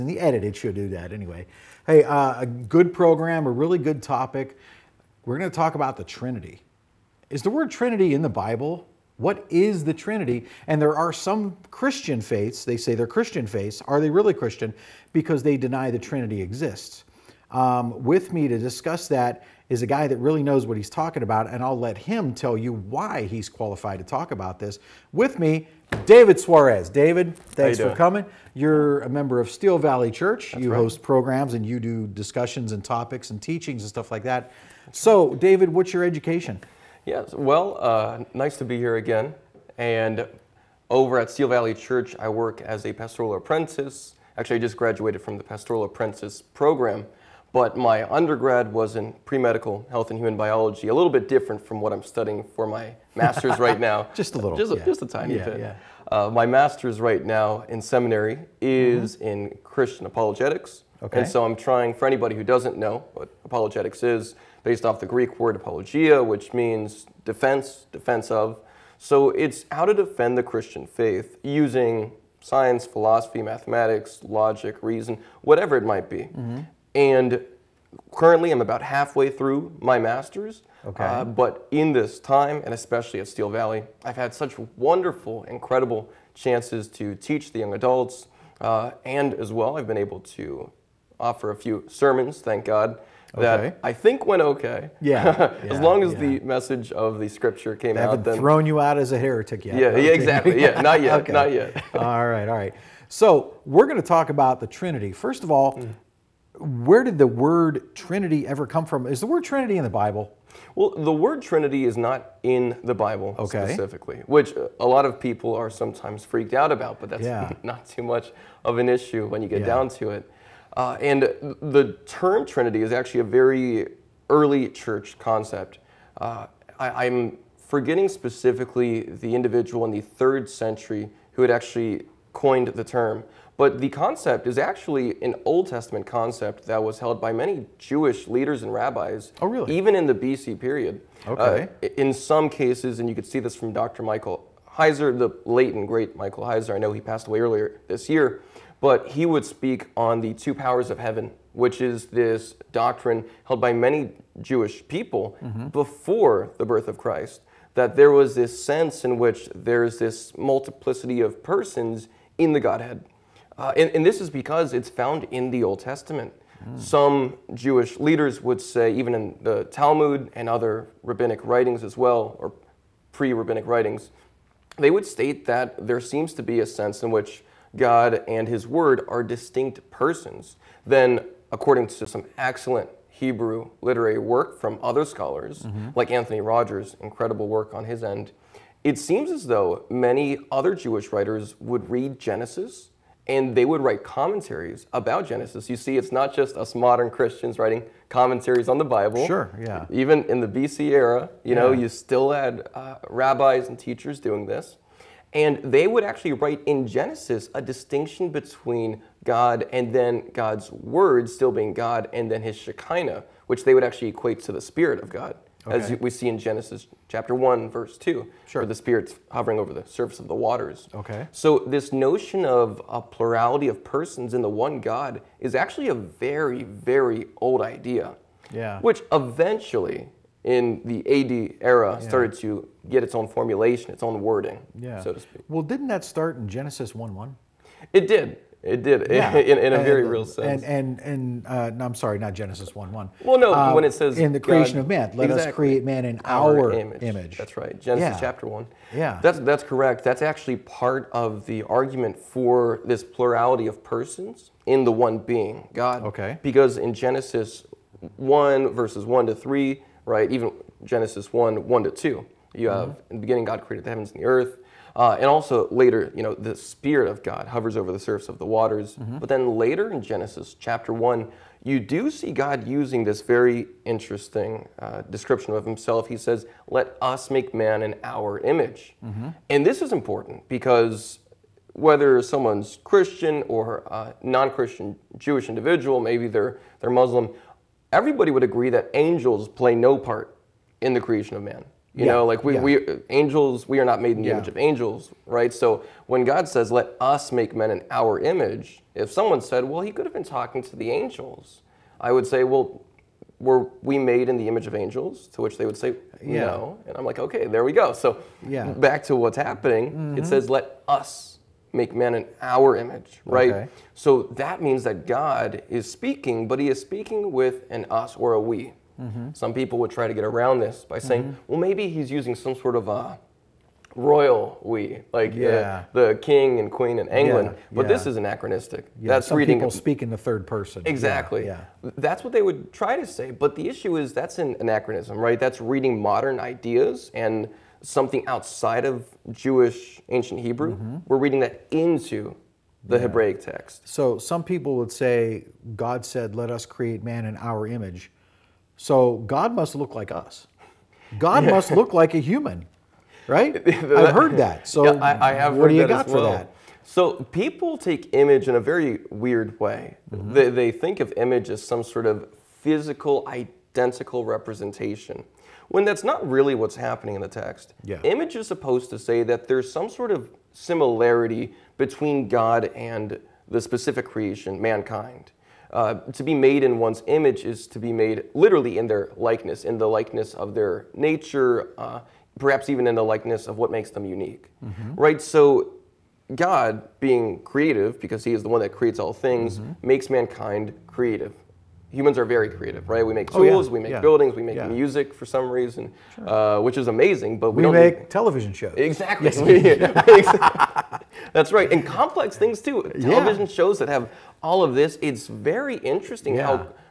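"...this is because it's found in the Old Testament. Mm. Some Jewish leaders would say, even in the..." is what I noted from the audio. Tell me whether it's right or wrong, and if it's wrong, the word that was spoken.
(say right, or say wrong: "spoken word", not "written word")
right.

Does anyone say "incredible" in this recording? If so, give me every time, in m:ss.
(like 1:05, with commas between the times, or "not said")
1:25, 3:07.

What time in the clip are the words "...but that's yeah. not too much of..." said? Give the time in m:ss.
1:57.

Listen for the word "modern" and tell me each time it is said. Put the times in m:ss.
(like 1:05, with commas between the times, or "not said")
3:16, 5:36.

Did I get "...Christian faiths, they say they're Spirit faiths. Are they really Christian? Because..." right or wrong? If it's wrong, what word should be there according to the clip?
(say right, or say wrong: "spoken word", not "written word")
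wrong: "Christian", not "Spirit".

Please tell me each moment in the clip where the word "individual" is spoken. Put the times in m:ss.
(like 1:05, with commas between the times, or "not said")
2:09, 4:45.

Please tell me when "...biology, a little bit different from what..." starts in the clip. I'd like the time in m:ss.
0:50.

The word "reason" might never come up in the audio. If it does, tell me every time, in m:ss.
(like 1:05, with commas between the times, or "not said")
1:14, 6:35.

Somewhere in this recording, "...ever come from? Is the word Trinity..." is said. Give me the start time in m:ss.
1:48.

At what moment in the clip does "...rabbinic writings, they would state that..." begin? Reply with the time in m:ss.
2:53.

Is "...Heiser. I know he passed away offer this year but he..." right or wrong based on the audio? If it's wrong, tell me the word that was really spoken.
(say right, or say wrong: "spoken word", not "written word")
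wrong: "earlier", not "offer".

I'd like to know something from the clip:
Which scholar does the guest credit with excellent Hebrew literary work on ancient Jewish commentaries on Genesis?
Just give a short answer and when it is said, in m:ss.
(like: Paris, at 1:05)
Anthony Rogers, at 3:06.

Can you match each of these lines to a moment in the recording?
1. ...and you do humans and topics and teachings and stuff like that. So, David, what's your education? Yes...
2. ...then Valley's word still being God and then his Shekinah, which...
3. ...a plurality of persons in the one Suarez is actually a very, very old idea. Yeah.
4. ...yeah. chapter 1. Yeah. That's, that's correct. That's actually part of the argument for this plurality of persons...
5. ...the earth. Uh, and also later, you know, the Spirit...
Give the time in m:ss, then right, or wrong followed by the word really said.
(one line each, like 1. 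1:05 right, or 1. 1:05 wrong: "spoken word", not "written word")
1. 0:31 wrong: "discussions", not "humans"
2. 3:29 wrong: "God", not "Valley"
3. 3:42 wrong: "God", not "Suarez"
4. 4:08 right
5. 4:24 right.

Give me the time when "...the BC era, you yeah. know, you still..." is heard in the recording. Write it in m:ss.
3:20.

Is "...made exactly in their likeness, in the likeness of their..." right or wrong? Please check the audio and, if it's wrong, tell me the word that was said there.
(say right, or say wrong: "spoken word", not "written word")
wrong: "literally", not "exactly".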